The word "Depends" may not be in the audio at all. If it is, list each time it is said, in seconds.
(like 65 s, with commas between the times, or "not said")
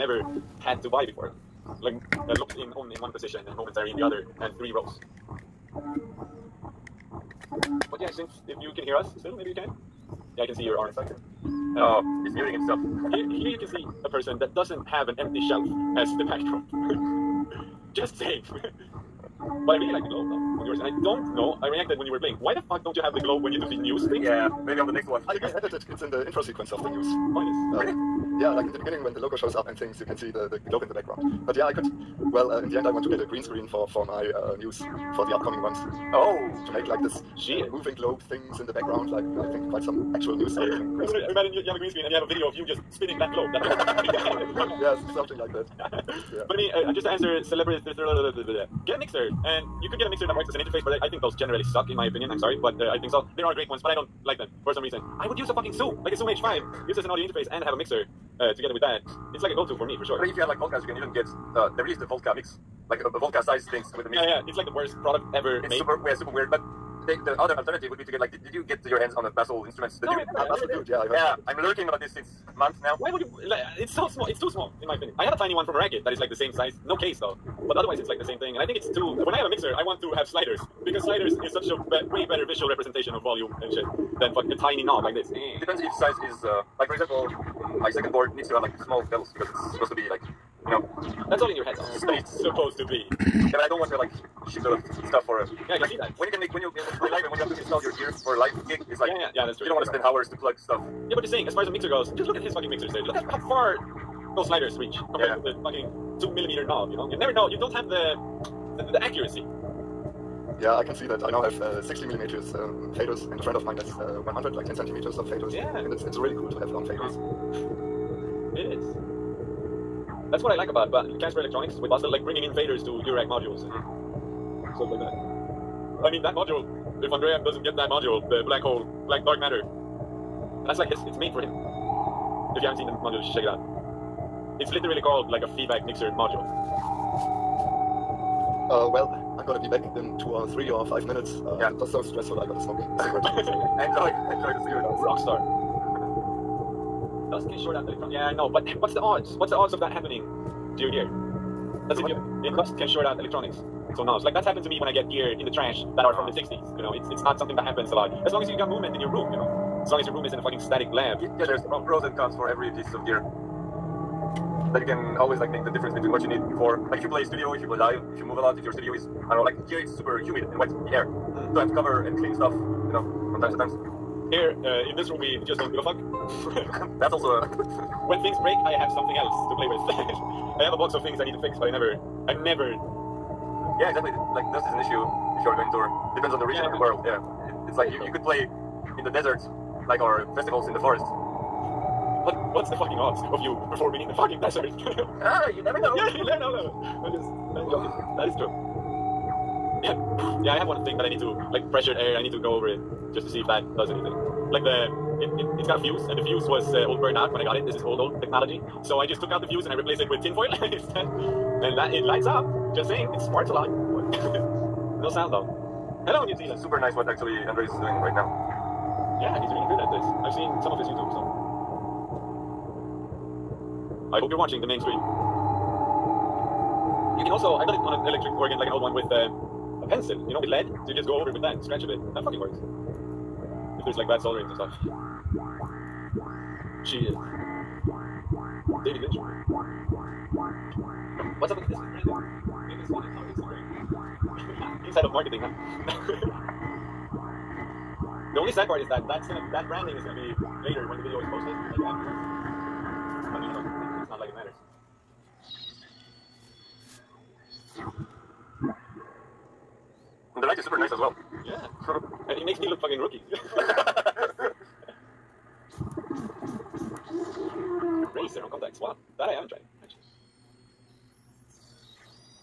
85 s, 186 s.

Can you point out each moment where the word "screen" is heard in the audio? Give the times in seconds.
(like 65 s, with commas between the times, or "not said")
33 s, 41 s.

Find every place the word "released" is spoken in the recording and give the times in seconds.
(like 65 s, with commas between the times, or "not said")
61 s.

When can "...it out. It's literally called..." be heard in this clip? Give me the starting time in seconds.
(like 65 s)
133 s.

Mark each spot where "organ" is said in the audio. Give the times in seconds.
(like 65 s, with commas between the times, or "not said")
228 s.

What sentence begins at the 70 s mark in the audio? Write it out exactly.
The no, dude, I never, uh, Bastl dude.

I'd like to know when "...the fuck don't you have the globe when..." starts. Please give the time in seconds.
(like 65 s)
22 s.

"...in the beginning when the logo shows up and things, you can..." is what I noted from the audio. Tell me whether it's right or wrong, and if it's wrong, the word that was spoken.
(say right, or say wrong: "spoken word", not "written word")
right.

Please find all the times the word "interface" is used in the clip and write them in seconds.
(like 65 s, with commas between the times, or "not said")
50 s, 57 s.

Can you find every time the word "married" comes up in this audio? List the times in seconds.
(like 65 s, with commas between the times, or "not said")
not said.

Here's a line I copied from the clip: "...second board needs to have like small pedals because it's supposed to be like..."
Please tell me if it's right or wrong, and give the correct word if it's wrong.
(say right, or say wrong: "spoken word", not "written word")
right.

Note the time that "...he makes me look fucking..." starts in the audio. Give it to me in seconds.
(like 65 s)
262 s.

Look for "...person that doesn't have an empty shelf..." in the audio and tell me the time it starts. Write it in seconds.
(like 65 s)
14 s.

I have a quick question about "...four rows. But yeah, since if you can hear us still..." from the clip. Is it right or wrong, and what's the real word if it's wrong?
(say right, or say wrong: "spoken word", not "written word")
wrong: "three", not "four".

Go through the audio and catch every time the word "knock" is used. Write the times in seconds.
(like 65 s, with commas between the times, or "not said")
not said.